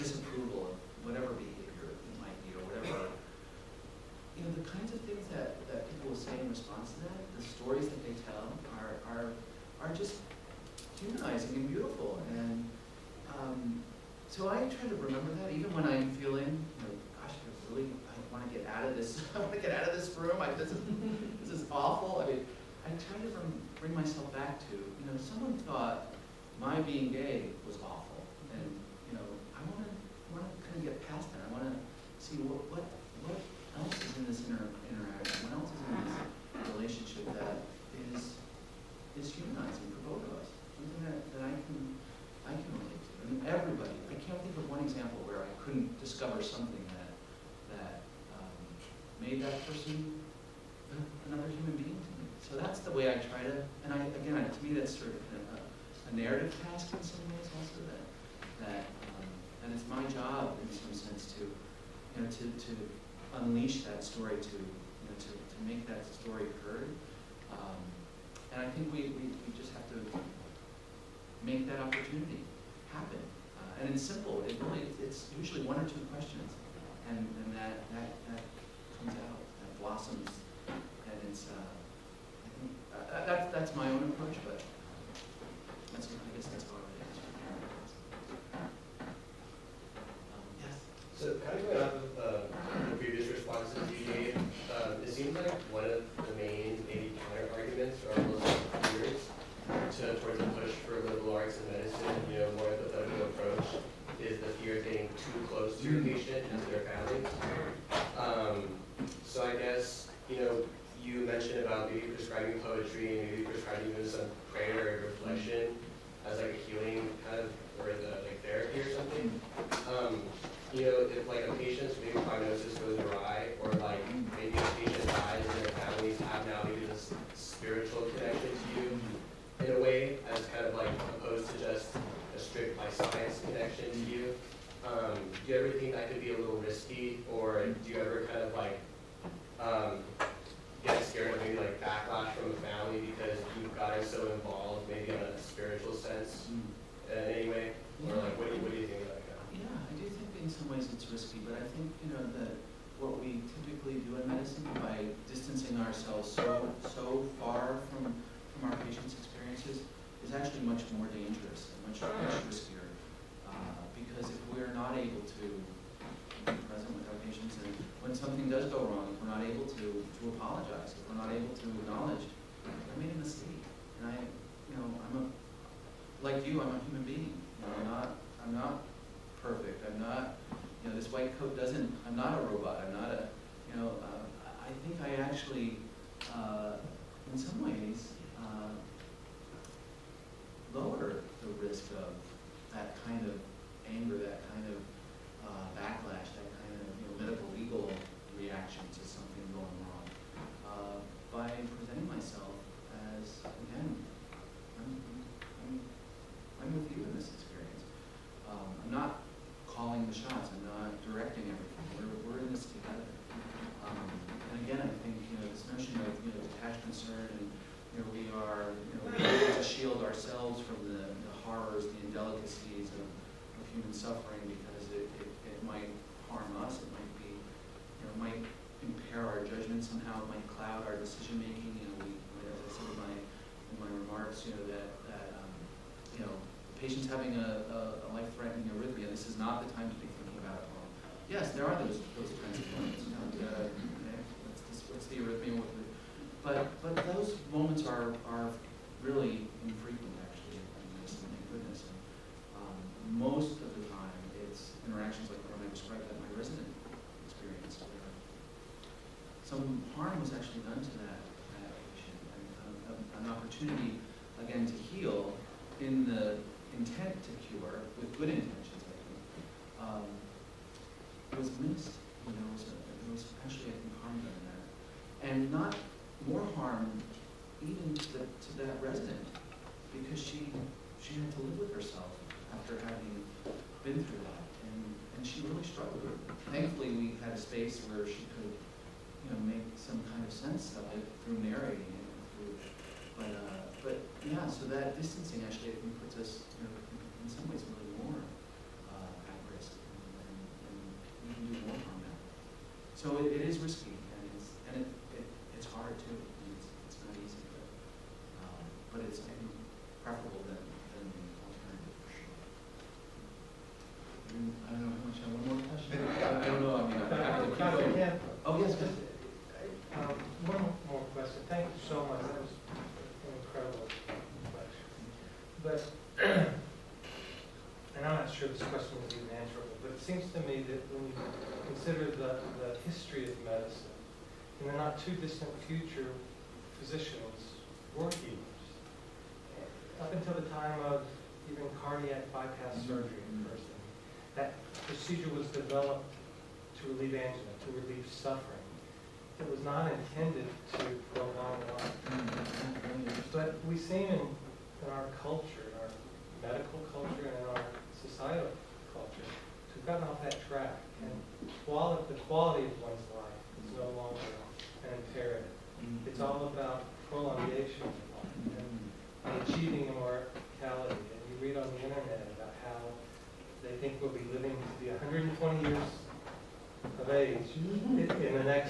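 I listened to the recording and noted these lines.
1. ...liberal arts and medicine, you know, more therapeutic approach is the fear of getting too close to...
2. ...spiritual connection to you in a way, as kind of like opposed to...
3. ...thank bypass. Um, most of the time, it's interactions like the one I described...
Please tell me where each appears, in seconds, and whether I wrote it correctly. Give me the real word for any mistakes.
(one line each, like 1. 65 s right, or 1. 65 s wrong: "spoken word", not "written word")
1. 101 s right
2. 127 s right
3. 251 s wrong: "goodness", not "bypass".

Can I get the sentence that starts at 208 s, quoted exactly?
Um, I'm not calling the shots.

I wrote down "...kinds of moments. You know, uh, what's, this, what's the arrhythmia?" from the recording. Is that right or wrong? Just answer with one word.
right.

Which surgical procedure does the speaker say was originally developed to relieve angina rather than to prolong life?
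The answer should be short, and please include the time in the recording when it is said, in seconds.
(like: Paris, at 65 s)
cardiac bypass, at 341 s.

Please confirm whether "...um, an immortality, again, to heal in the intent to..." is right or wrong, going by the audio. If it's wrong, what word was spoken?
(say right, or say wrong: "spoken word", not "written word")
wrong: "opportunity", not "immortality".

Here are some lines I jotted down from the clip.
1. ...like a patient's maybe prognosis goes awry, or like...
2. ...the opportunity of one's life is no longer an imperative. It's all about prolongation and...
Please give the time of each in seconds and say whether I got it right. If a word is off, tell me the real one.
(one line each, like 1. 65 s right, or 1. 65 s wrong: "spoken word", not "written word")
1. 121 s right
2. 362 s wrong: "quality", not "opportunity".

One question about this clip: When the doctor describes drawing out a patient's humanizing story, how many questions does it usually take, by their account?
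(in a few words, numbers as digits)
one or two.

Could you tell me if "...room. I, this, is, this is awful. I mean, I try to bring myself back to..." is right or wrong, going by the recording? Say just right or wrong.
right.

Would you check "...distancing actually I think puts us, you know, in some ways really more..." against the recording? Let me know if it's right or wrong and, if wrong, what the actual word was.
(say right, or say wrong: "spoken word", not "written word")
right.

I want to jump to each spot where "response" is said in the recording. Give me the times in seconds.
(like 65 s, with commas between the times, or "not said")
6 s, 93 s.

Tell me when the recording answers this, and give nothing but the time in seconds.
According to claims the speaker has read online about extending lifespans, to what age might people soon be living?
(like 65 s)
374 s.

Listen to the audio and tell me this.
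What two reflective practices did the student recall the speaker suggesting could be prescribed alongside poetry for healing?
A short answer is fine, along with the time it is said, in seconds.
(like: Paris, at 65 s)
prayer and reflection, at 114 s.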